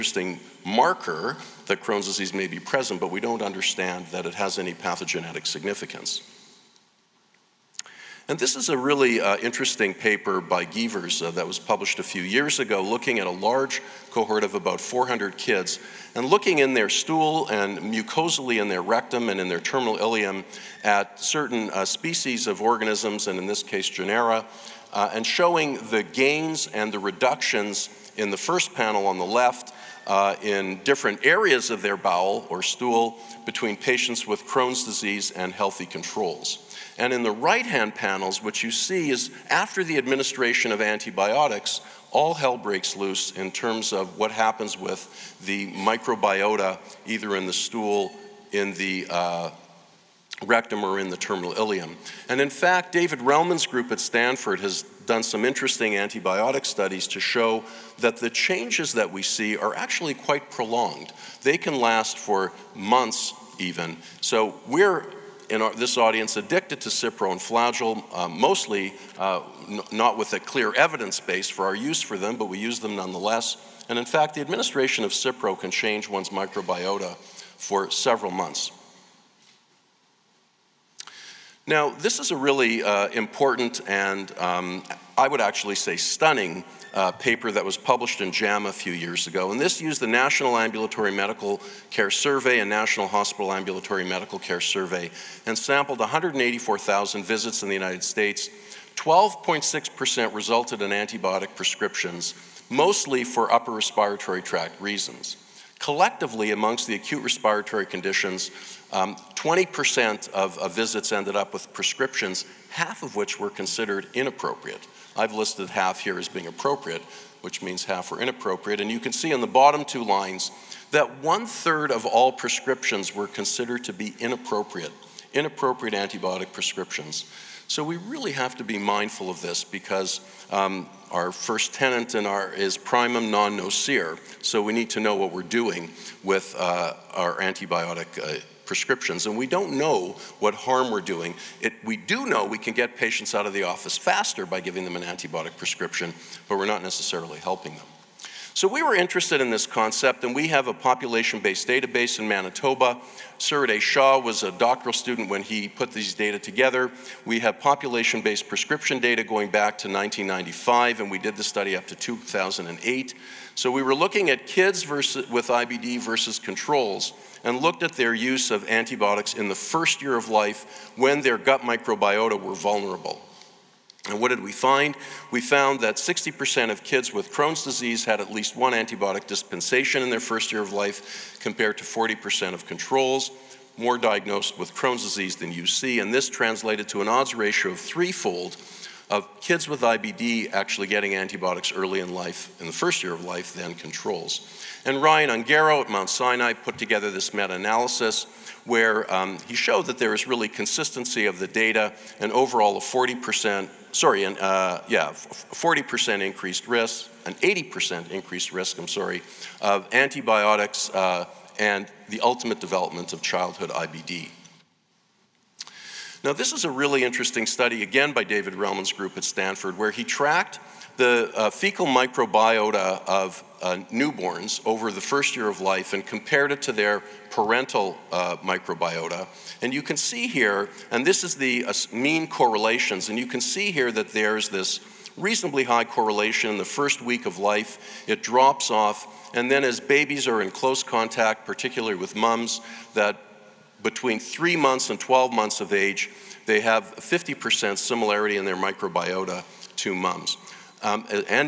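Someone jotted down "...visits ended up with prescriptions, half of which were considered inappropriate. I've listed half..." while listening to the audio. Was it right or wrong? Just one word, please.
right.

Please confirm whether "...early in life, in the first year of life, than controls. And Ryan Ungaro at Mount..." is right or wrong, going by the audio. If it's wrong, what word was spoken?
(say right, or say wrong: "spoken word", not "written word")
right.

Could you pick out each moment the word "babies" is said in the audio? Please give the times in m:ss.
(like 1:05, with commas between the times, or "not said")
3:59.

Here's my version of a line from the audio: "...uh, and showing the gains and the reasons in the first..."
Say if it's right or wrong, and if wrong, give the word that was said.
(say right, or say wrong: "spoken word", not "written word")
wrong: "reductions", not "reasons".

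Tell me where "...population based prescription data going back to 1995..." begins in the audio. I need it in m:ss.
2:37.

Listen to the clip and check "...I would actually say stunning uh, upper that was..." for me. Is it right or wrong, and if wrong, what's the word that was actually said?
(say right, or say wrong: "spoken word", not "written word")
wrong: "paper", not "upper".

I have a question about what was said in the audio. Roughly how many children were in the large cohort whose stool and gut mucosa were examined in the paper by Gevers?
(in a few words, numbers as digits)
400.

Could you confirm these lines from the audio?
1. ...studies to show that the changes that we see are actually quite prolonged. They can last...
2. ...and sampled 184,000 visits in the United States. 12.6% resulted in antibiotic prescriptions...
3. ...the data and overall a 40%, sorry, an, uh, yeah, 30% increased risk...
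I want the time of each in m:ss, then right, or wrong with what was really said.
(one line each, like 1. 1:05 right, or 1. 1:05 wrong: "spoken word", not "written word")
1. 0:56 right
2. 1:35 right
3. 3:21 wrong: "40", not "30".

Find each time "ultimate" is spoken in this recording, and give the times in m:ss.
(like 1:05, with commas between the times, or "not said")
3:32.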